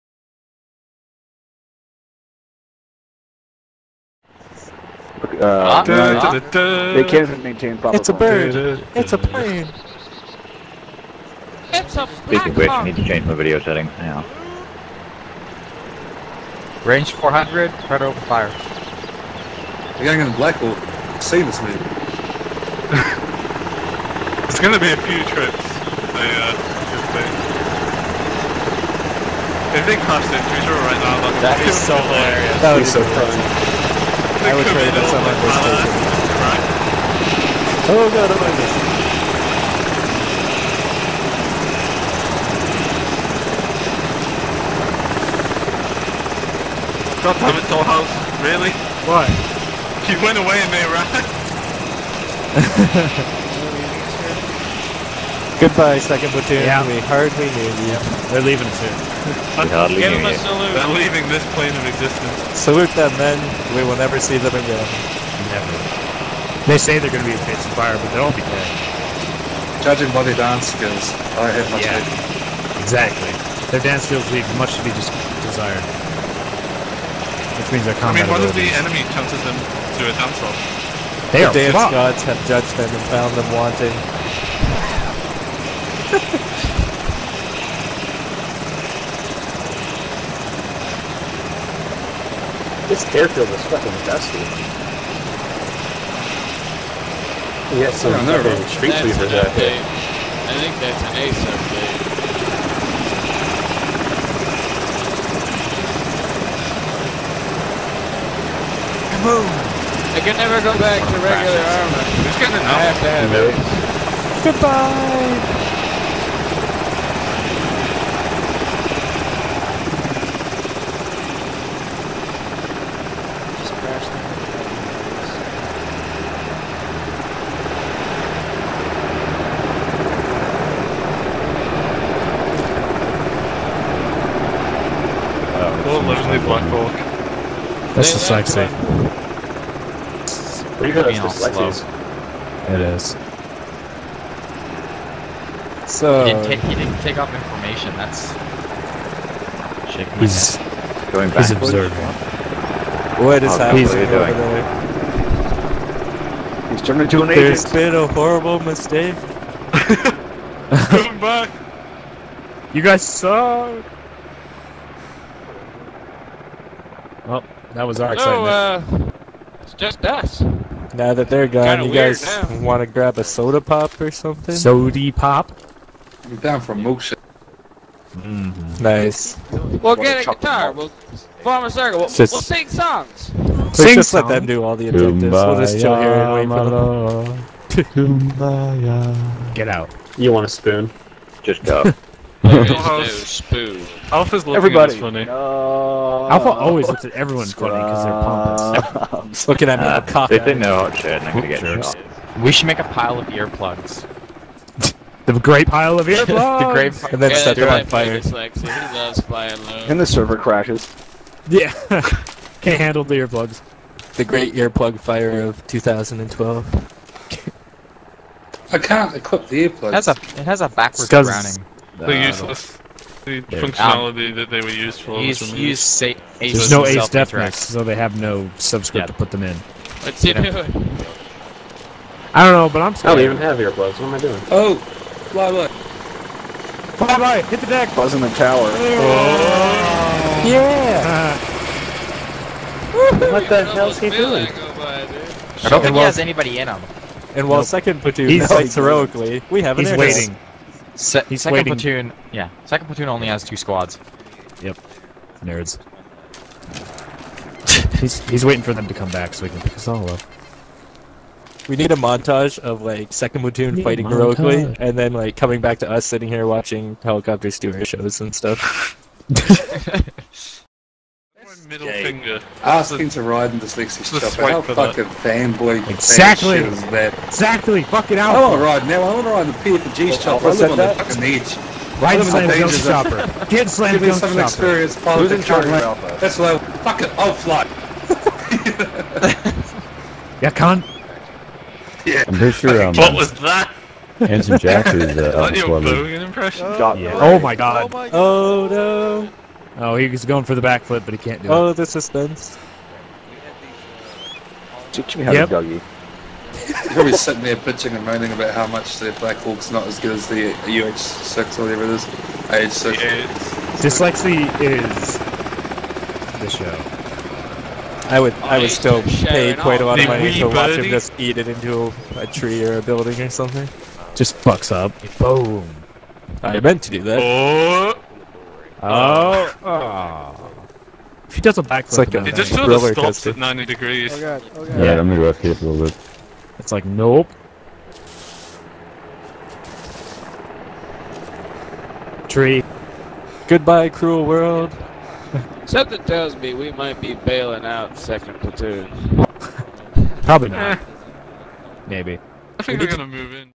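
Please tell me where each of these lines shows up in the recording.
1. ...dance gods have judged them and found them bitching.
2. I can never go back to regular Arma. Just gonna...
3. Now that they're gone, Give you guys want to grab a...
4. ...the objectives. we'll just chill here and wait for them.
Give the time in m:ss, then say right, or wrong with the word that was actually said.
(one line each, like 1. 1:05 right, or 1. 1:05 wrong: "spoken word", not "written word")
1. 1:21 wrong: "wanting", not "bitching"
2. 1:50 right
3. 2:50 wrong: "Kinda", not "Give"
4. 3:04 right.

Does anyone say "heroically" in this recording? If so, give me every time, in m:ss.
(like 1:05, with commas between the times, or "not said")
4:08, 4:24.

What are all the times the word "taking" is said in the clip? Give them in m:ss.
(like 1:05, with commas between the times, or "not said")
0:35.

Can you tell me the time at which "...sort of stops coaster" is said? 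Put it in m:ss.
5:32.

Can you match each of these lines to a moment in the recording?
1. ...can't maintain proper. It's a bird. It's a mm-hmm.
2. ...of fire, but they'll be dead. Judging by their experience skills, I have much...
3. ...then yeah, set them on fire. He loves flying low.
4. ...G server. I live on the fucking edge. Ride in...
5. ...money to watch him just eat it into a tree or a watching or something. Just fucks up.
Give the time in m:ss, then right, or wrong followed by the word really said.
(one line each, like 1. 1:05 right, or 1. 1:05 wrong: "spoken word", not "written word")
1. 0:07 right
2. 1:07 wrong: "dance", not "experience"
3. 3:27 right
4. 4:39 wrong: "shopper", not "server"
5. 5:20 wrong: "building", not "watching".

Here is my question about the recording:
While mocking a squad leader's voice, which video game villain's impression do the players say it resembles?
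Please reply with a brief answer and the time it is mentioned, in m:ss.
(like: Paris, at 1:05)
Handsome Jack, at 4:54.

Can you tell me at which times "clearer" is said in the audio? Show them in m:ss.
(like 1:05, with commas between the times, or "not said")
not said.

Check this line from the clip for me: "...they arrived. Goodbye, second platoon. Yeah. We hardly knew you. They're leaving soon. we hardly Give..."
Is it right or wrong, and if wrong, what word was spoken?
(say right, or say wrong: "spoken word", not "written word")
right.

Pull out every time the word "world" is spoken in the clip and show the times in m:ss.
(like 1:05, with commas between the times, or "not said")
5:44.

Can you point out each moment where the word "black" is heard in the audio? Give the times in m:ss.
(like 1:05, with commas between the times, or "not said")
0:20, 2:16, 5:09.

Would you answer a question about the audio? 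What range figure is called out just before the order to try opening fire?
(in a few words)
400.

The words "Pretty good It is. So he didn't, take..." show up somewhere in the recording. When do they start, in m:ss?
2:20.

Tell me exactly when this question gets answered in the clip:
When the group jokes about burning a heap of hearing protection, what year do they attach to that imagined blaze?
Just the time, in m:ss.
3:35.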